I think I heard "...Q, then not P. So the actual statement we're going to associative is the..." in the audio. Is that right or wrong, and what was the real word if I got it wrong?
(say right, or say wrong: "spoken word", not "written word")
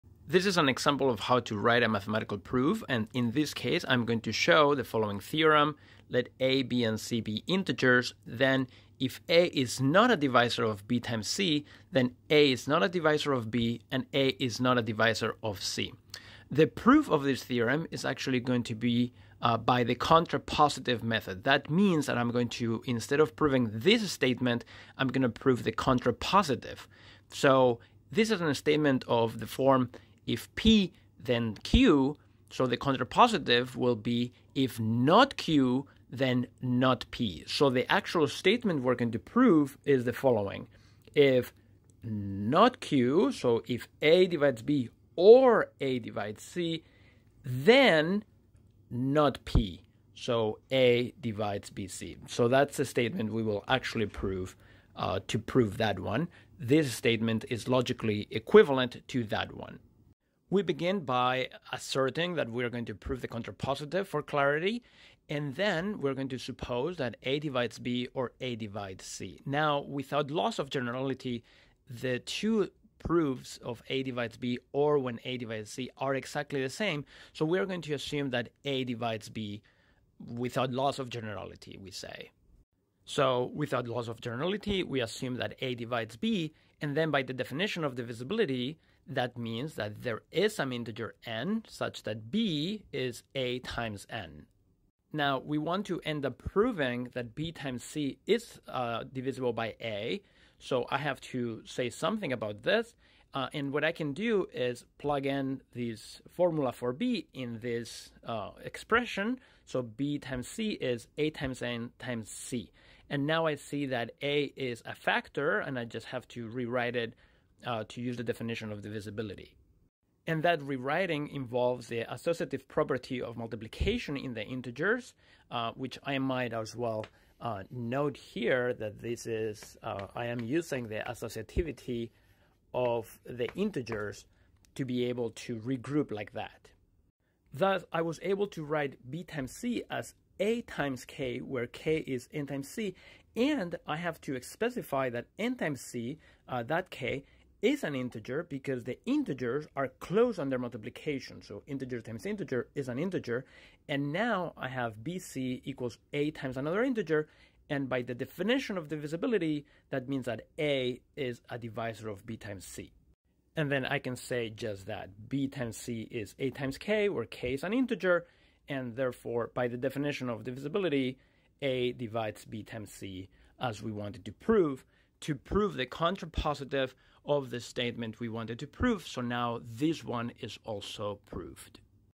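wrong: "prove", not "associative".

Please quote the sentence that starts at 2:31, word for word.
So integer times integer is an integer.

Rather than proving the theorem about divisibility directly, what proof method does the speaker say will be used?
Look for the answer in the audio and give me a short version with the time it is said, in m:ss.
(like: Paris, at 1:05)
contrapositive method, at 0:19.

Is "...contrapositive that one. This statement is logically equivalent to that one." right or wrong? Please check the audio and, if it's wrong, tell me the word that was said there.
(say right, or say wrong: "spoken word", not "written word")
wrong: "prove", not "contrapositive".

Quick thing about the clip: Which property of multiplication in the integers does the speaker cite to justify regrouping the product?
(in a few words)
associative property.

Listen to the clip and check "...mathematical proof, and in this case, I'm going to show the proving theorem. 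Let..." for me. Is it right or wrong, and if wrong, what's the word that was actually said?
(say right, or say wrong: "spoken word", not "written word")
wrong: "following", not "proving".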